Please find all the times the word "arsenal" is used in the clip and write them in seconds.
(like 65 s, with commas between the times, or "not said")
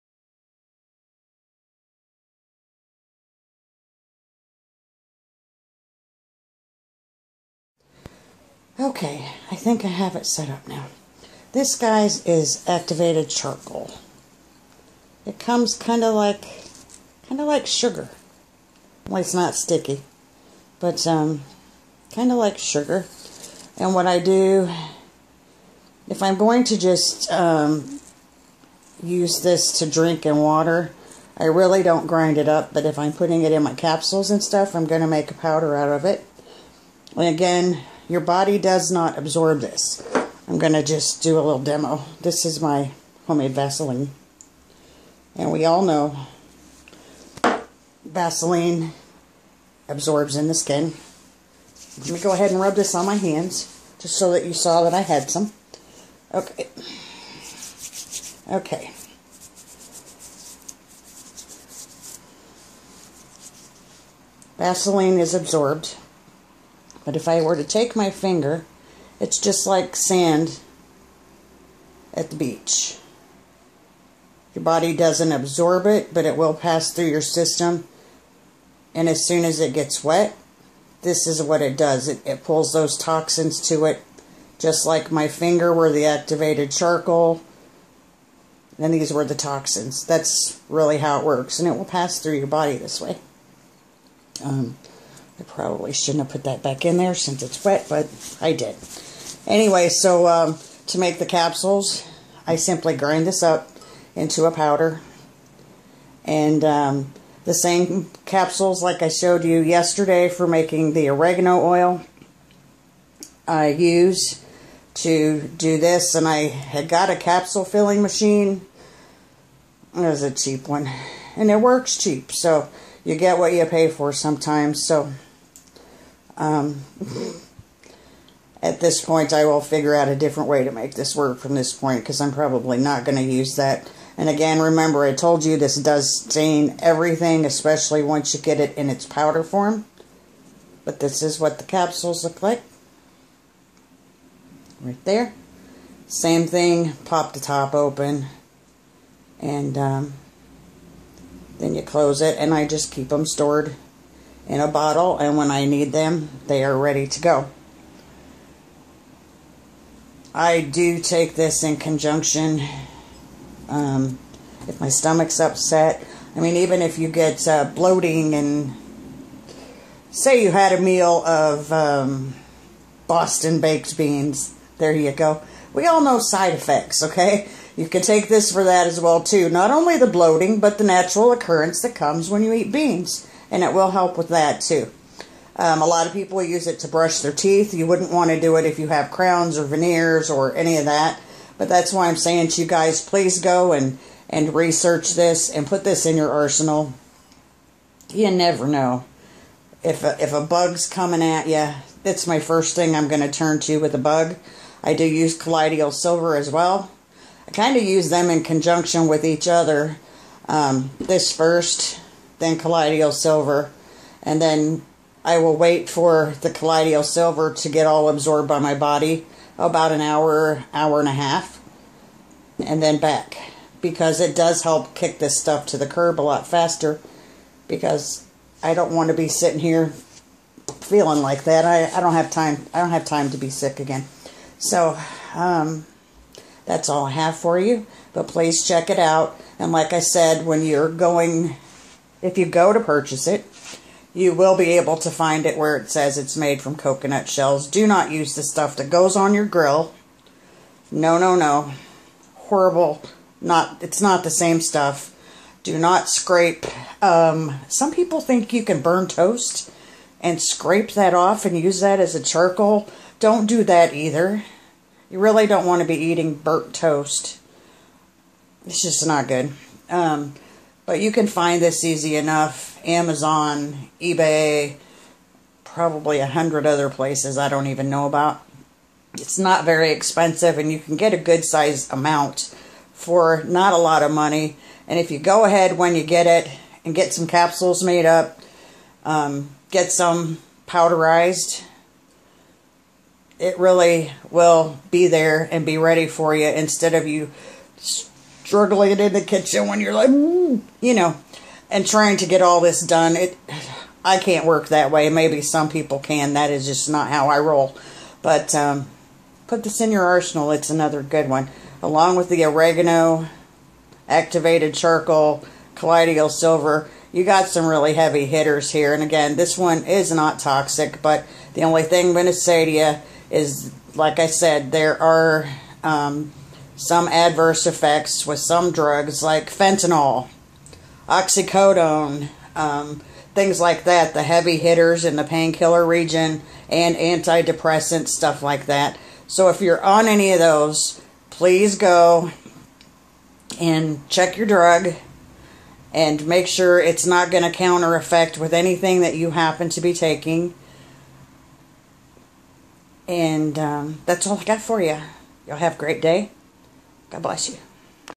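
196 s, 310 s.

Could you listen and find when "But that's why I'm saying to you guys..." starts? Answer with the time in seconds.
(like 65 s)
191 s.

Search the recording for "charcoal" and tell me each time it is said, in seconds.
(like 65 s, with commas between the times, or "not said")
13 s, 86 s, 262 s, 314 s.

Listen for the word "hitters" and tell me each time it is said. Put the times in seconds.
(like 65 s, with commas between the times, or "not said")
318 s, 334 s.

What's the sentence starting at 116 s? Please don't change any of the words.
And I had got a capsule filling machine.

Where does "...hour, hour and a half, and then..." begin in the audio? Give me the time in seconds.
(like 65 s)
220 s.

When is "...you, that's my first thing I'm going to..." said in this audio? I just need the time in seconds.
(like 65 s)
201 s.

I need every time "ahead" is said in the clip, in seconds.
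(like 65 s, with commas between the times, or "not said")
52 s, 285 s.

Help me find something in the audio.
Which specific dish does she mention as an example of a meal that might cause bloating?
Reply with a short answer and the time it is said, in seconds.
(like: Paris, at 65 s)
Boston baked beans, at 173 s.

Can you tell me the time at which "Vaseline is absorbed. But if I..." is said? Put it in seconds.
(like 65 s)
64 s.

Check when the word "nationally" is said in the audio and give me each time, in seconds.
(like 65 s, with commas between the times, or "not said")
not said.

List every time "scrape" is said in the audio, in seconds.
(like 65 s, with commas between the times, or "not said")
256 s, 260 s.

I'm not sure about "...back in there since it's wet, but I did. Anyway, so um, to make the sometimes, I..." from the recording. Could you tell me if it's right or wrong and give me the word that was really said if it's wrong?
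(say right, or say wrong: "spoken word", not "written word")
wrong: "capsules", not "sometimes".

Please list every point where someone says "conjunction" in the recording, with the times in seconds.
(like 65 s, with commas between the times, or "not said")
161 s, 208 s.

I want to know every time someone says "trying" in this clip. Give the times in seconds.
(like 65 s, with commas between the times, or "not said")
301 s.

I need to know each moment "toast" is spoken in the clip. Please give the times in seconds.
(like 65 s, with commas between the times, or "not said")
259 s, 266 s.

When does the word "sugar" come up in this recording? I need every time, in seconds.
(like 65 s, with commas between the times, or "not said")
17 s, 22 s.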